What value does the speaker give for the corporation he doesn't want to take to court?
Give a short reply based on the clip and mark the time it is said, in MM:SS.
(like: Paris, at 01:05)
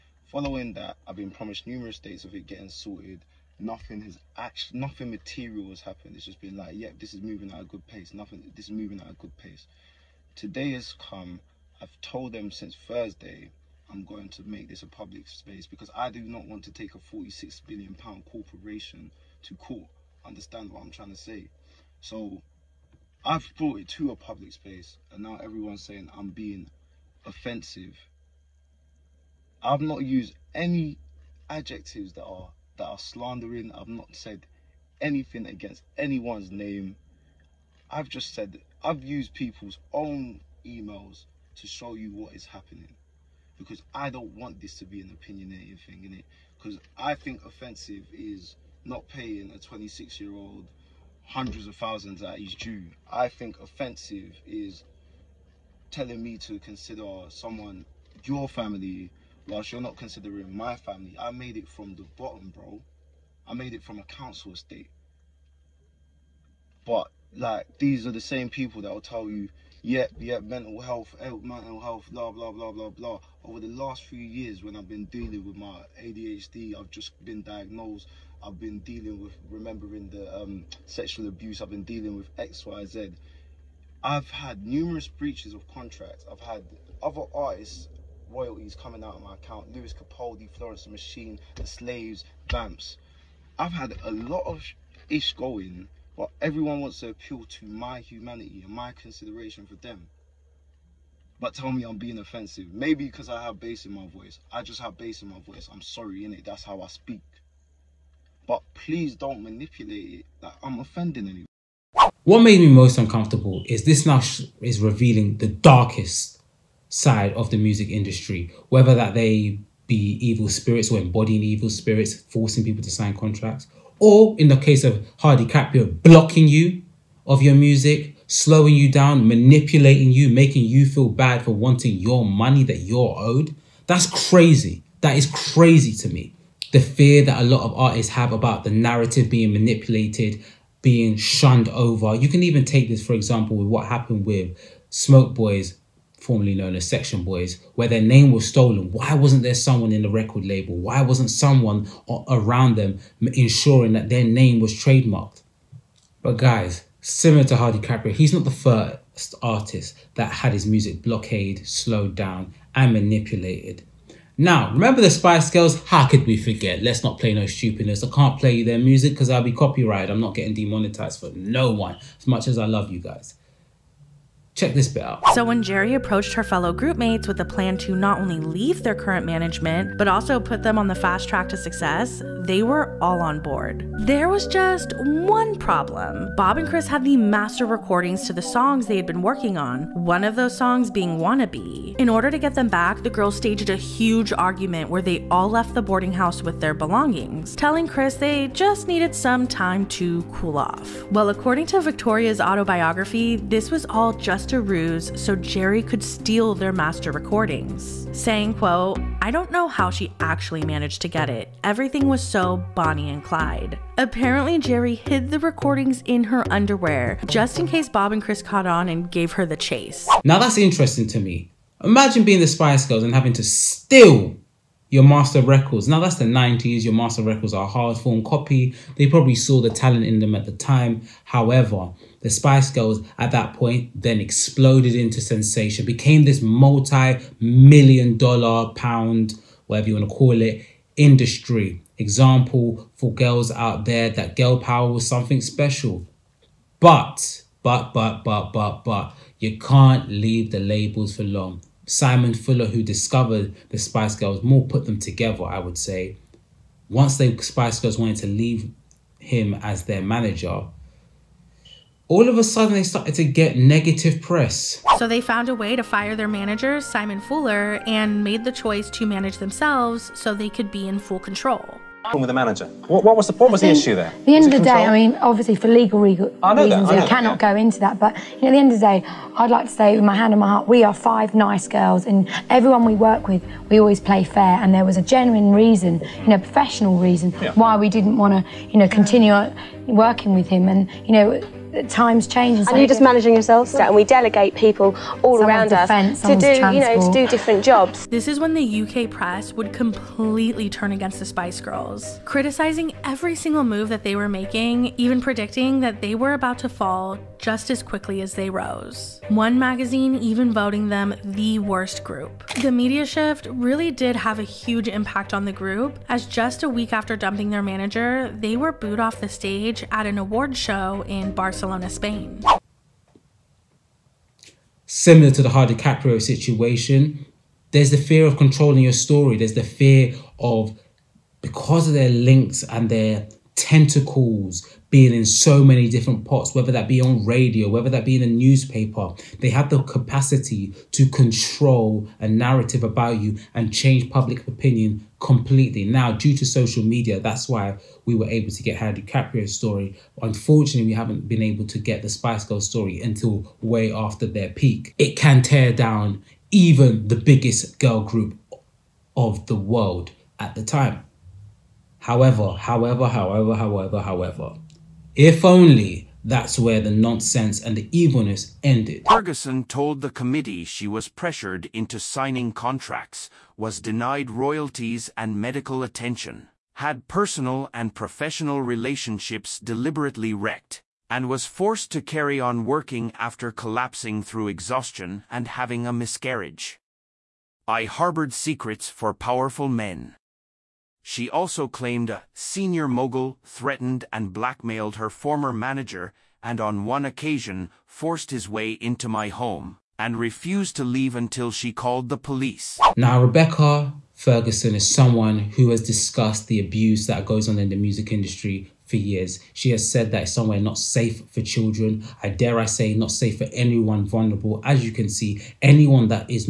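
£46 billion, at 00:16.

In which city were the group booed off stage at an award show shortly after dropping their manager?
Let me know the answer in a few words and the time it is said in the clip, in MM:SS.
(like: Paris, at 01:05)
Barcelona, at 05:21.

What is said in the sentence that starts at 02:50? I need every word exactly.
I'm not getting demonetized for no one, as much as I love you guys.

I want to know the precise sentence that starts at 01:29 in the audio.
Lewis Capaldi, Florence the Machine, The Slaves, Vamps.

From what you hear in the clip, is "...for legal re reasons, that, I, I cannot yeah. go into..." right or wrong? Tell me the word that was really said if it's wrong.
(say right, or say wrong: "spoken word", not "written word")
right.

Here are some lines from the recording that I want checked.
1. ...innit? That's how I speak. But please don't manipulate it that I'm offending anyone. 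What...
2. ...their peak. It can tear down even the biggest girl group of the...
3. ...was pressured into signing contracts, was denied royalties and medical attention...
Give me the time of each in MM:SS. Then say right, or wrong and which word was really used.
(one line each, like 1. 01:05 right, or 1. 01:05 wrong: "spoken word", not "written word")
1. 01:46 right
2. 05:54 right
3. 06:10 right.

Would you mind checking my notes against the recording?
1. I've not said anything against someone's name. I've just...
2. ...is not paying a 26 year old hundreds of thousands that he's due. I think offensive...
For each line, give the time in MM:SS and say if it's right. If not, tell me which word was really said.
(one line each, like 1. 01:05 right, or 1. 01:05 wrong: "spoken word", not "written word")
1. 00:33 wrong: "anyone", not "someone"
2. 00:48 right.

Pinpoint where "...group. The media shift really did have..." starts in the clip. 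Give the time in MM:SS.
05:12.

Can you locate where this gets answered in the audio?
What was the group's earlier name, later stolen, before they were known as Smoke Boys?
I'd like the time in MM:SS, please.
02:26.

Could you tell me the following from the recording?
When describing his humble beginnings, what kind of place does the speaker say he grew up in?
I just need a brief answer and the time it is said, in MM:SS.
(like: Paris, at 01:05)
A council estate, at 01:04.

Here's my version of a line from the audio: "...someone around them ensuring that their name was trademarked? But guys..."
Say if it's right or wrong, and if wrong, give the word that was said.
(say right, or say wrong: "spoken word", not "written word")
right.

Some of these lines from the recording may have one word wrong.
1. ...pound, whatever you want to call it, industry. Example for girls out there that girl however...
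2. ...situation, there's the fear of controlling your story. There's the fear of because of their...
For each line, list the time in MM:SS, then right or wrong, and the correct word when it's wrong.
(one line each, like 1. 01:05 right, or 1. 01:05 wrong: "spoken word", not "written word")
1. 03:58 wrong: "power", not "however"
2. 05:26 right.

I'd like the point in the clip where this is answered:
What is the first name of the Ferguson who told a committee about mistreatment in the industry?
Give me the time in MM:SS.
06:43.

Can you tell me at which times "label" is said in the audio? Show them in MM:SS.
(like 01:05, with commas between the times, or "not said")
02:30, 04:10.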